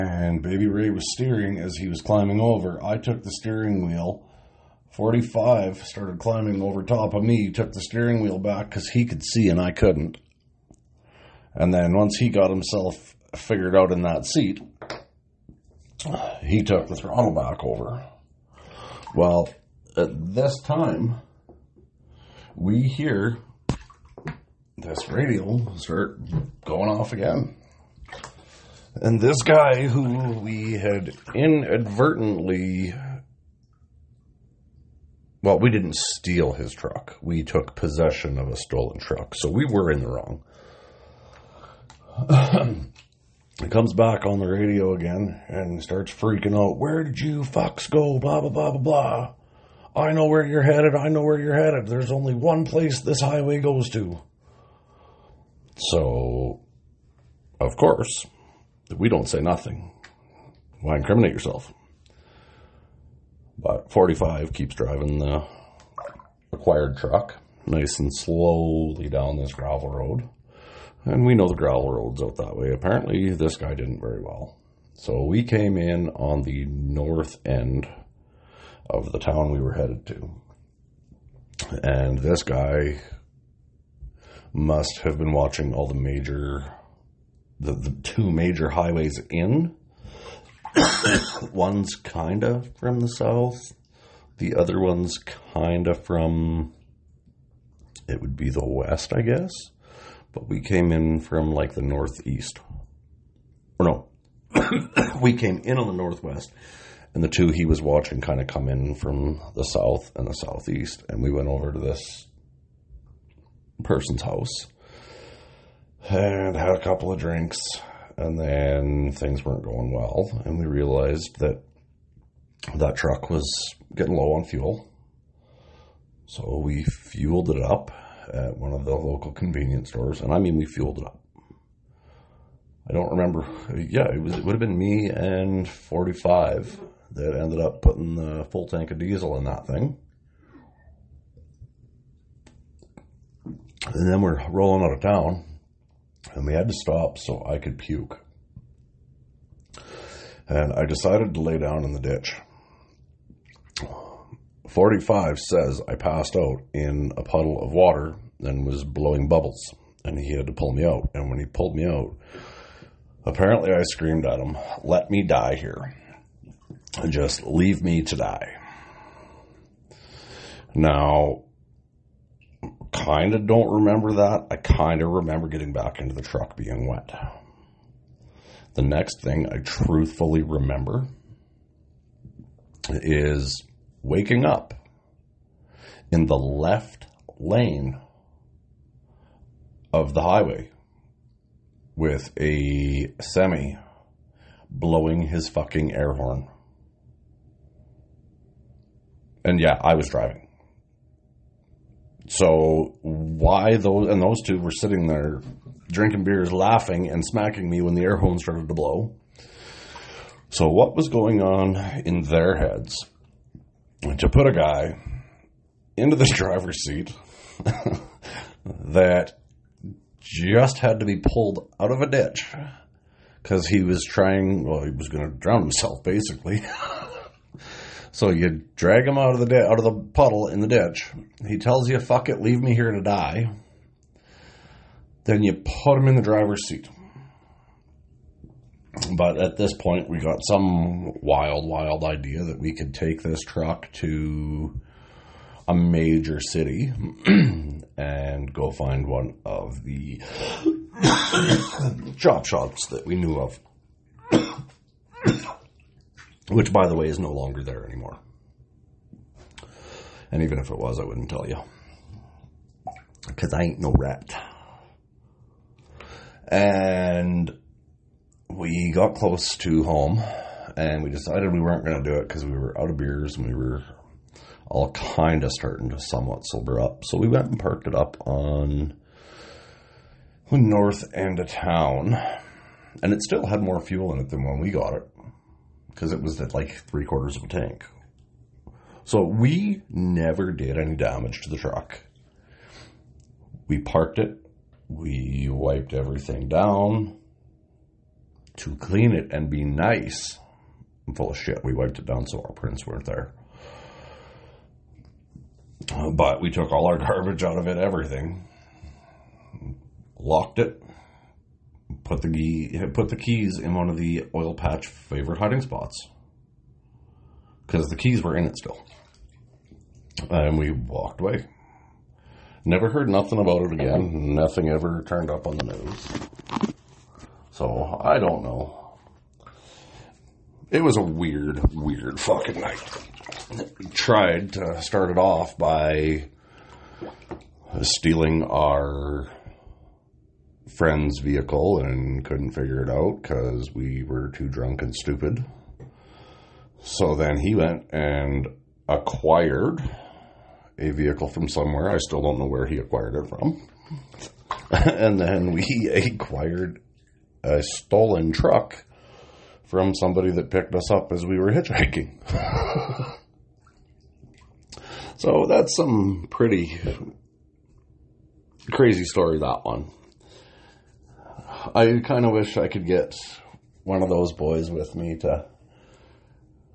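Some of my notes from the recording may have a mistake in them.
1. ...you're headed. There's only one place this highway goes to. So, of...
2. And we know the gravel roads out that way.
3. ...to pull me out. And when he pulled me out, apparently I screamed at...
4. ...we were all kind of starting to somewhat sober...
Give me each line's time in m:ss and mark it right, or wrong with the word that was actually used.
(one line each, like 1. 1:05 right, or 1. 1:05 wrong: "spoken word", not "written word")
1. 0:51 right
2. 1:11 right
3. 2:40 right
4. 4:33 right.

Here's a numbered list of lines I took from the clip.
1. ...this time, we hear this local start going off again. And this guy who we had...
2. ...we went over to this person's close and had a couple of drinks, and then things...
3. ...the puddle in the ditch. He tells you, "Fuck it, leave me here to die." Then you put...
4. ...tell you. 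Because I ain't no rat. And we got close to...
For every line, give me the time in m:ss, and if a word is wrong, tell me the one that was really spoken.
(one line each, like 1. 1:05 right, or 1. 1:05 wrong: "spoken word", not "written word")
1. 0:20 wrong: "radial", not "local"
2. 1:51 wrong: "house", not "close"
3. 3:49 right
4. 4:21 right.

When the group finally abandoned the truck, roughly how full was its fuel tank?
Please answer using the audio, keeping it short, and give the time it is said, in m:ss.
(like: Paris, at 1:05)
three quarters, at 4:46.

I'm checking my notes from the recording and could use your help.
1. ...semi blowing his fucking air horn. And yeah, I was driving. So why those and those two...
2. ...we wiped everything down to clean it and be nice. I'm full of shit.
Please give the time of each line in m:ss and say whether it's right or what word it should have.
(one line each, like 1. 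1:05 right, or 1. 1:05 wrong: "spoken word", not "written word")
1. 3:13 right
2. 4:54 right.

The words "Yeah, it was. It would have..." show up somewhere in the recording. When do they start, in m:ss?
2:13.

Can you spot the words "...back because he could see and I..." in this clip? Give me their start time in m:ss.
0:08.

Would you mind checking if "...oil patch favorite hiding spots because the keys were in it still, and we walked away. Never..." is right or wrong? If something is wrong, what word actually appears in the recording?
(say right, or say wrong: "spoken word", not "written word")
right.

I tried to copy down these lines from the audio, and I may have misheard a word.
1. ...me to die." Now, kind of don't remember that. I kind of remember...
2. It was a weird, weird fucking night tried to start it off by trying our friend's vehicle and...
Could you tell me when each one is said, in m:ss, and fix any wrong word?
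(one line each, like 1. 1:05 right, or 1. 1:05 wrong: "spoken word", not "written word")
1. 2:47 right
2. 5:30 wrong: "stealing", not "trying".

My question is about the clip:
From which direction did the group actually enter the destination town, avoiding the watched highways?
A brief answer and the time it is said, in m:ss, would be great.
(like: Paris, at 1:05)
northwest, at 1:45.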